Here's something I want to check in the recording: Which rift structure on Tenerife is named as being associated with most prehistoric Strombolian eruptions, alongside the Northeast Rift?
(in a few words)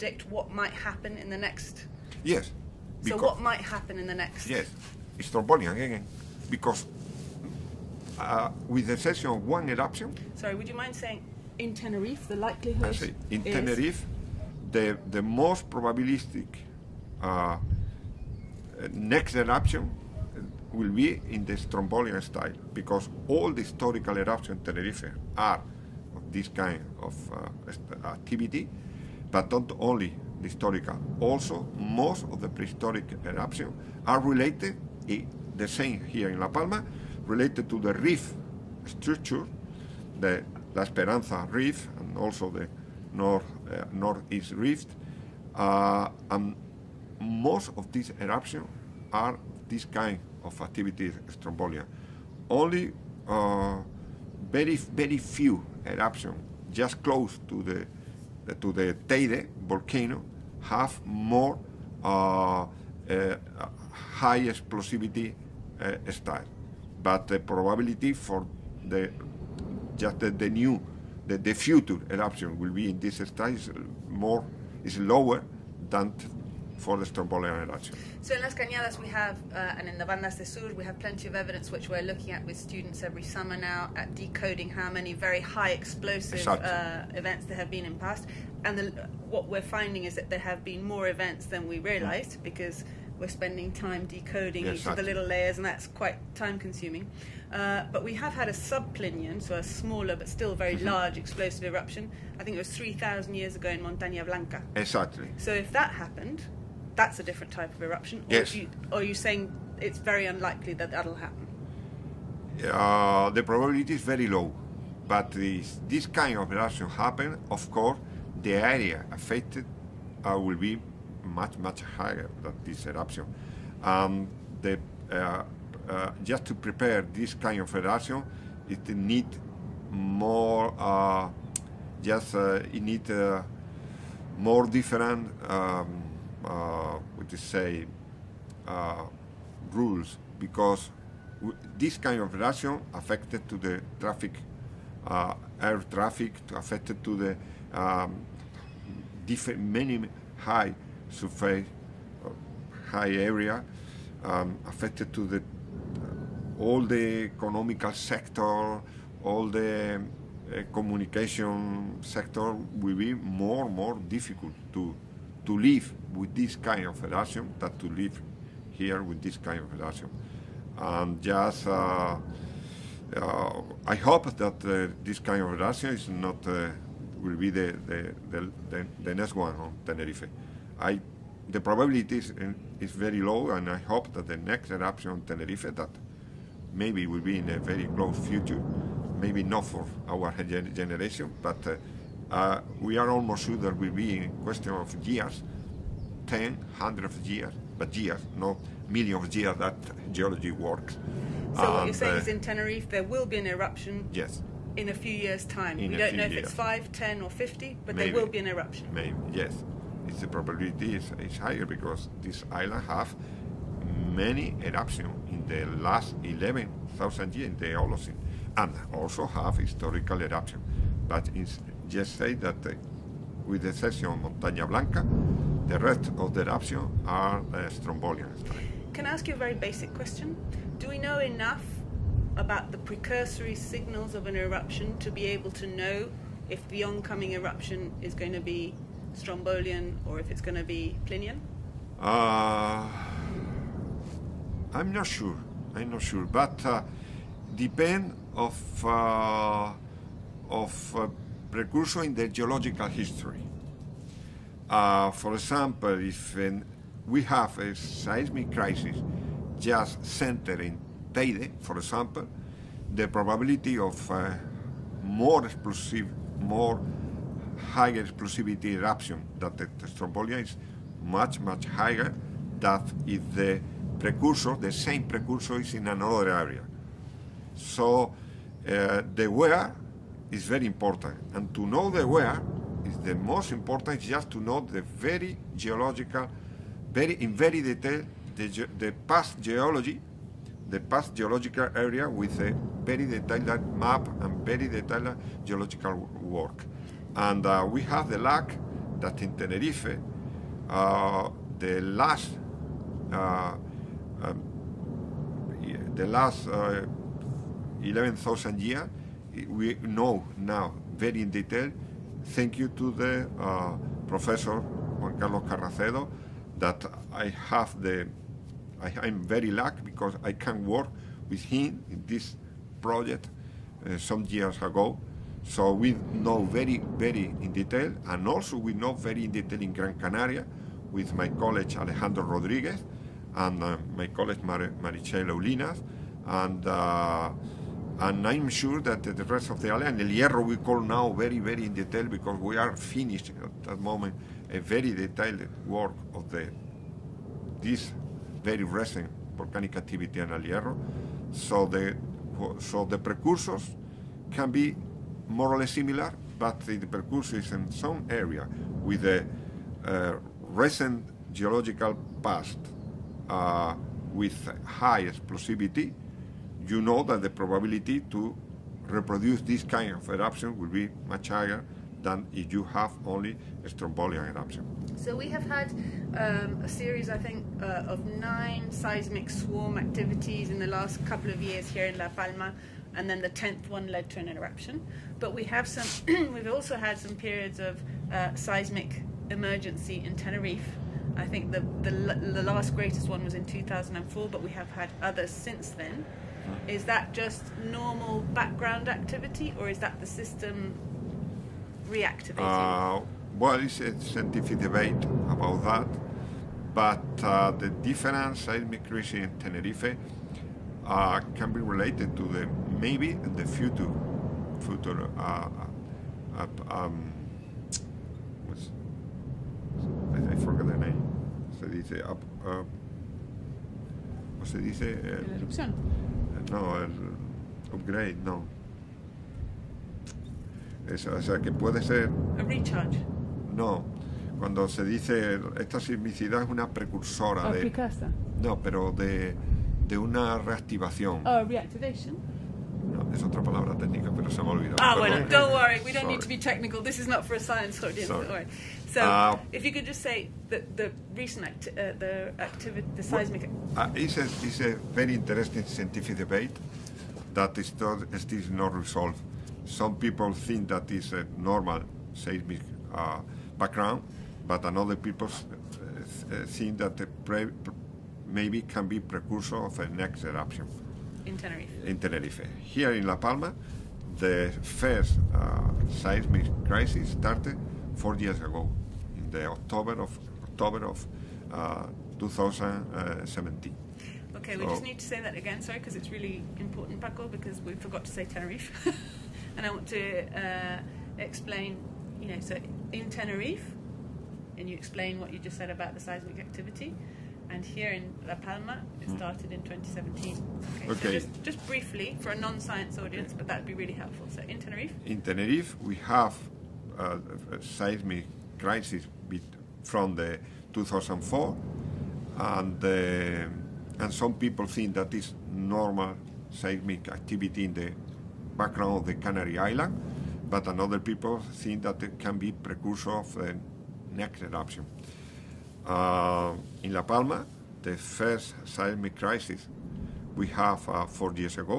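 La Esperanza rift.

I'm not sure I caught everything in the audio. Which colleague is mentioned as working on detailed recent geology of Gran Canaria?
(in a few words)
Alejandro Rodriguez.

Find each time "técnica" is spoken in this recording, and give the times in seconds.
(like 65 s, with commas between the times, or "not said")
443 s.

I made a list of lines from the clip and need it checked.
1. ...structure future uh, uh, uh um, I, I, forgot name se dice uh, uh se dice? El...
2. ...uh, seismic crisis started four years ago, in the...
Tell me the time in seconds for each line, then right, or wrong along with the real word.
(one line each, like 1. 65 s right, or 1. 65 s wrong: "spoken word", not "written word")
1. 413 s wrong: "future", not "structure"
2. 475 s right.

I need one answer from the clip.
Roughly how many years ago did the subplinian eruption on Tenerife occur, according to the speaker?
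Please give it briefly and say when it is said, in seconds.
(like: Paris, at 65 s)
3,000 years, at 102 s.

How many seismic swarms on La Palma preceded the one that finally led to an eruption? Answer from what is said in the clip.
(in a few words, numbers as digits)
9.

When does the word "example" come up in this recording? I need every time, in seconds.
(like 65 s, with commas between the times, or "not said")
255 s, 261 s.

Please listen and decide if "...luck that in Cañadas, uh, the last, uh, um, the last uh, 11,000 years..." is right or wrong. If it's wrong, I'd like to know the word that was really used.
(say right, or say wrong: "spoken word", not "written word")
wrong: "Tenerife", not "Cañadas".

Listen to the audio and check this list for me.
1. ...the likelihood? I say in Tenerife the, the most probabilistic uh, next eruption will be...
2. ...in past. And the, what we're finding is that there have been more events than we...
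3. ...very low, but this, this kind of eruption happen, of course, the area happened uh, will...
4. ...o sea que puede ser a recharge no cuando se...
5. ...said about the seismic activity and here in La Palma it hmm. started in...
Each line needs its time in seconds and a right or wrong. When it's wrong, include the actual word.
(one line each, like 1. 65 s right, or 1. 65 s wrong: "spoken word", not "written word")
1. 12 s right
2. 87 s right
3. 114 s wrong: "affected", not "happened"
4. 431 s right
5. 495 s right.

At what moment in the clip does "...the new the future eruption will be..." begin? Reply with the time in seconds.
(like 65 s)
70 s.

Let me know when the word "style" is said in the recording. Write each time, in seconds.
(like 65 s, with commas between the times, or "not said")
22 s, 66 s.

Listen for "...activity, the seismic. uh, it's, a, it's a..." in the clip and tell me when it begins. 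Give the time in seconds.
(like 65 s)
452 s.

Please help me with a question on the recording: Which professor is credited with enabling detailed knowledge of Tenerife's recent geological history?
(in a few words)
Juan Carlos Carracedo.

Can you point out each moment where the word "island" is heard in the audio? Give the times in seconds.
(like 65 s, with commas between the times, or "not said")
212 s, 339 s, 519 s.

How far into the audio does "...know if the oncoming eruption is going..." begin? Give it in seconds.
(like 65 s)
235 s.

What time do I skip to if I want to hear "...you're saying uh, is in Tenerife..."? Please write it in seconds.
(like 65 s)
201 s.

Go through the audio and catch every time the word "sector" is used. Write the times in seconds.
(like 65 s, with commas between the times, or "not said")
157 s, 162 s.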